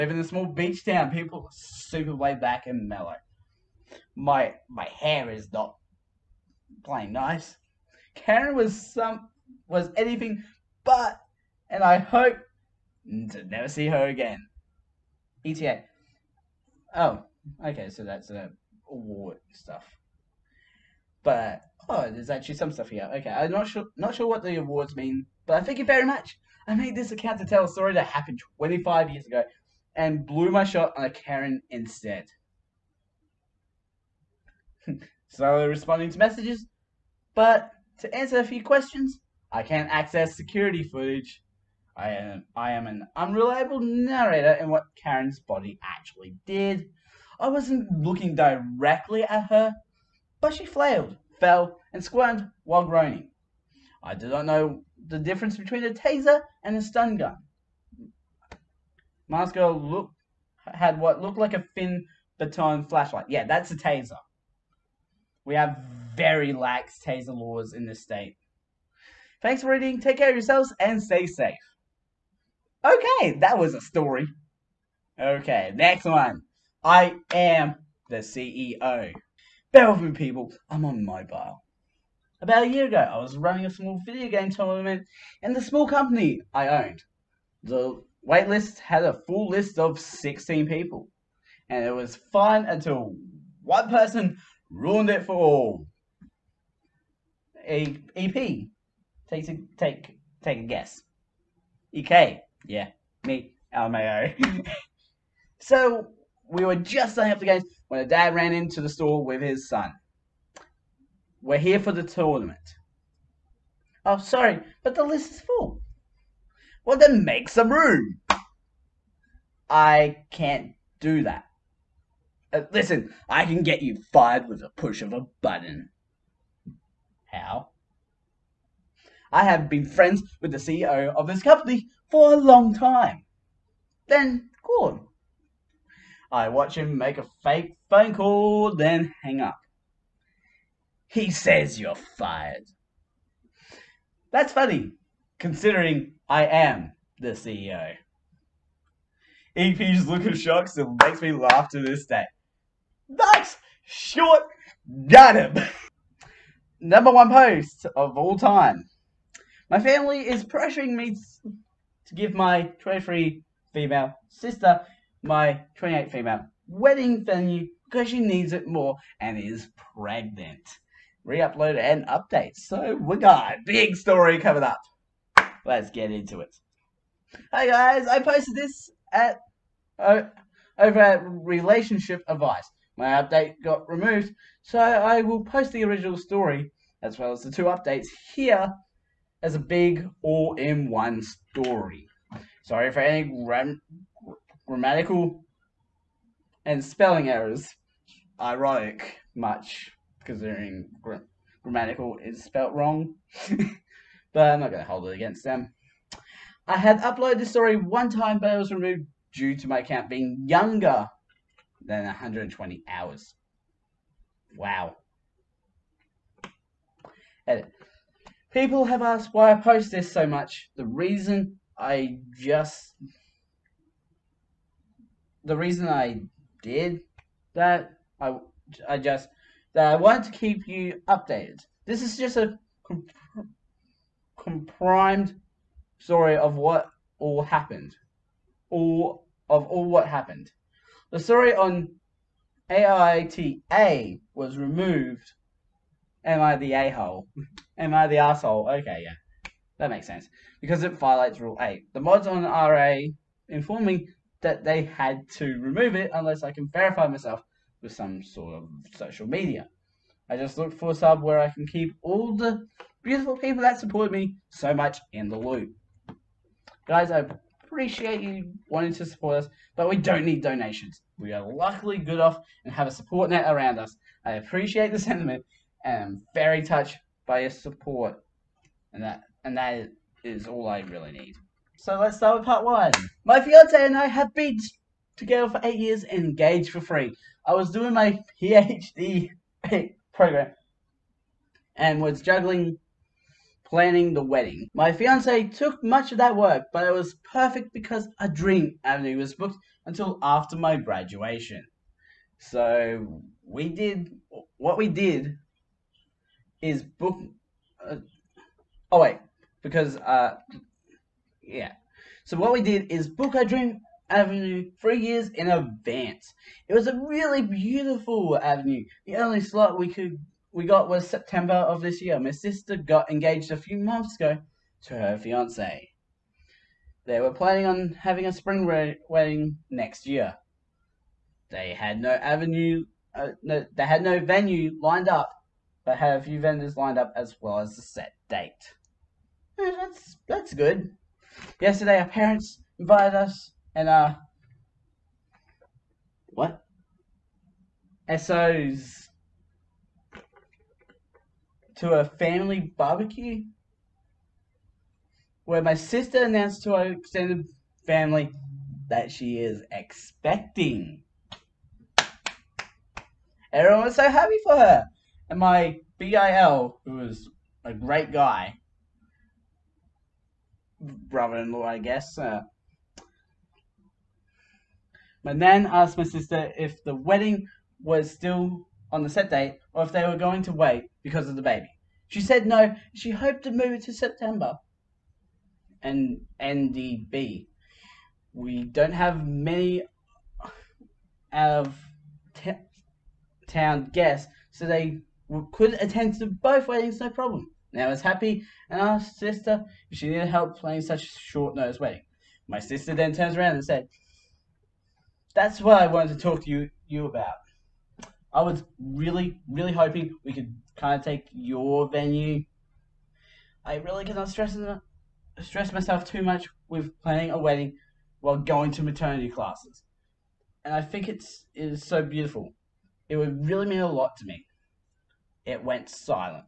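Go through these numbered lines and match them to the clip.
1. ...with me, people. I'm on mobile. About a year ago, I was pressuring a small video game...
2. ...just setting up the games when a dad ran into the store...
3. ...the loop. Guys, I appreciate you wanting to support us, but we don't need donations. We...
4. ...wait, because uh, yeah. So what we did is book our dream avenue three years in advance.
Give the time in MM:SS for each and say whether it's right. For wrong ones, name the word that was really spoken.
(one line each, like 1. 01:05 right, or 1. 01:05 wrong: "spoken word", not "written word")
1. 01:19 wrong: "running", not "pressuring"
2. 01:46 right
3. 04:25 right
4. 05:09 right.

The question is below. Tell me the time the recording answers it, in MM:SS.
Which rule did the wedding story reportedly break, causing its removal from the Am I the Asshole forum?
04:11.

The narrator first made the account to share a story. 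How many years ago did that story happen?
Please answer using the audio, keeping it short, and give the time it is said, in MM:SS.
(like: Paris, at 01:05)
25, at 00:28.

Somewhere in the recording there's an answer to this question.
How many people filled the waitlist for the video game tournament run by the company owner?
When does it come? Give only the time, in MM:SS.
01:30.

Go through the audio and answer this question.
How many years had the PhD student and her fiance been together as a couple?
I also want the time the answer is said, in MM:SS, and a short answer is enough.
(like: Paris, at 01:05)
8, at 04:45.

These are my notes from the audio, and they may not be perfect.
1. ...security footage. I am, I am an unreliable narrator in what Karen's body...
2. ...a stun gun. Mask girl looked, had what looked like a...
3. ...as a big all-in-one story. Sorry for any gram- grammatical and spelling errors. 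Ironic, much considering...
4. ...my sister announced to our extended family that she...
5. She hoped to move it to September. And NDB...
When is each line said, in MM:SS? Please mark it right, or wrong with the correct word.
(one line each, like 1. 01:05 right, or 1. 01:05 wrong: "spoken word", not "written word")
1. 00:40 right
2. 00:56 right
3. 03:09 right
4. 05:55 right
5. 06:22 right.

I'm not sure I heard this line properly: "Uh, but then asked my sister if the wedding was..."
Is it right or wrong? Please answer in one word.
right.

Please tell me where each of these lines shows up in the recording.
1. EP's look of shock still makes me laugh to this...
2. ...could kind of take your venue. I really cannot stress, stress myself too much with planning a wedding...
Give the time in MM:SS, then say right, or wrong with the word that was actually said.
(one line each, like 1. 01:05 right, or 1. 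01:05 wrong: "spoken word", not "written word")
1. 02:29 right
2. 06:50 right.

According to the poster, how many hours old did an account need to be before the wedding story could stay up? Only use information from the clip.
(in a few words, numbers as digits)
120.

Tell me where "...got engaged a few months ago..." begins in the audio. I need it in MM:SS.
05:22.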